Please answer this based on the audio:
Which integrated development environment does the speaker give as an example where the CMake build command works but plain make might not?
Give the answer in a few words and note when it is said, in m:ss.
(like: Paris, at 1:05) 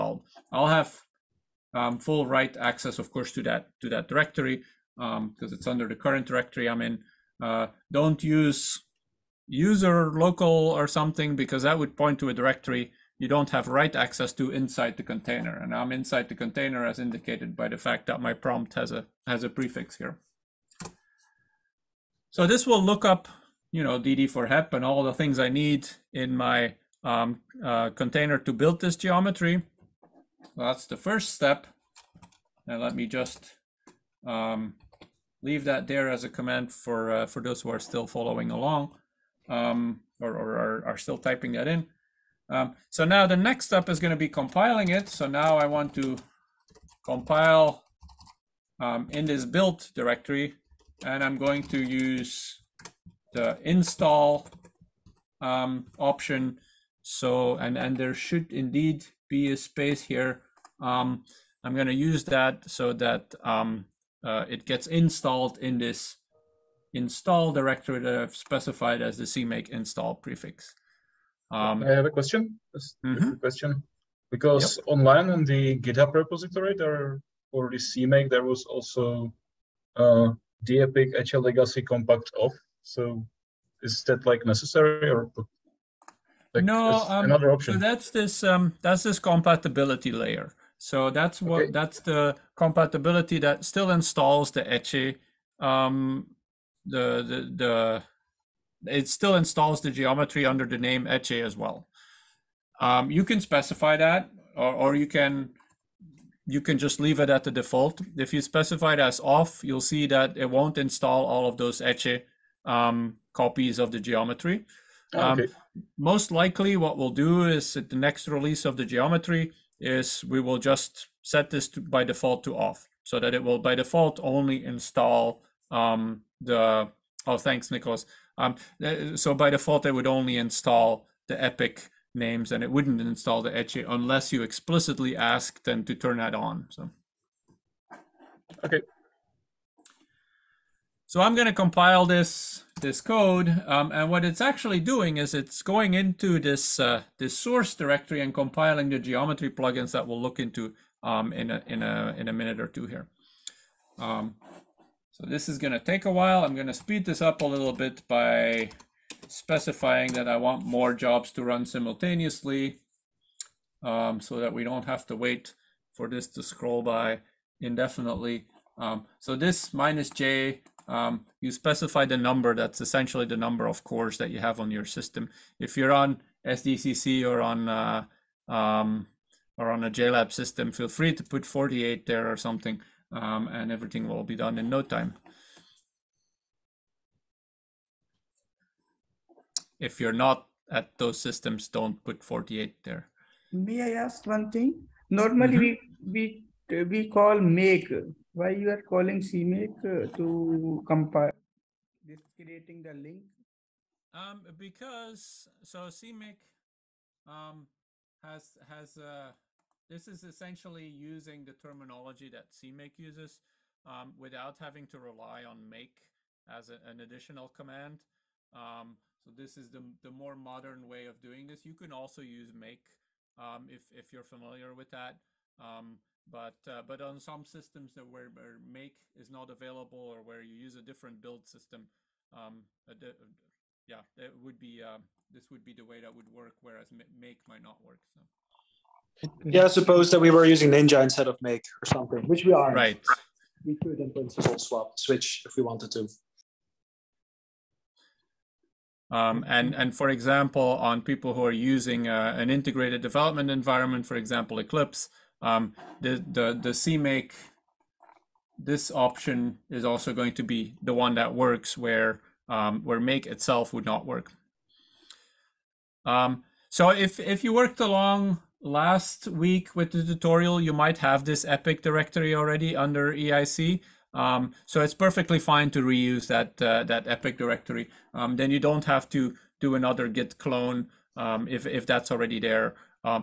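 Eclipse, at 4:14.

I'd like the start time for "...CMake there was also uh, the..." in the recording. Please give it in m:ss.
1:17.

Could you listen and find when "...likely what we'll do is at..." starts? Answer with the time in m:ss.
1:56.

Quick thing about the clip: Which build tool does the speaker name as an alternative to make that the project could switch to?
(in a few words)
Ninja.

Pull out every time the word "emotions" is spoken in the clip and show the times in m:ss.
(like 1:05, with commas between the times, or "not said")
not said.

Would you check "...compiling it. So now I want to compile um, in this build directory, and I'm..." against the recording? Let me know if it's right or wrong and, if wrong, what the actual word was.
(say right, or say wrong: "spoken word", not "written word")
right.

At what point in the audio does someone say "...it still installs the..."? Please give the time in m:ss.
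1:38.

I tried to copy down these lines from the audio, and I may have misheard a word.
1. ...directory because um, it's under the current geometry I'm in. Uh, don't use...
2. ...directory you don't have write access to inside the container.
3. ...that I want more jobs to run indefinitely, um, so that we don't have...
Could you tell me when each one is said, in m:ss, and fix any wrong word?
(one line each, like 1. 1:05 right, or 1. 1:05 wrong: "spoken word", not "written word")
1. 0:04 wrong: "directory", not "geometry"
2. 0:12 right
3. 2:40 wrong: "simultaneously", not "indefinitely".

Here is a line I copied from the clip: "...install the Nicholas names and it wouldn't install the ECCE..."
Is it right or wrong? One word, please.
wrong.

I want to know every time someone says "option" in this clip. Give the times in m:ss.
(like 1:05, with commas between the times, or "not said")
0:55, 1:27, 4:18.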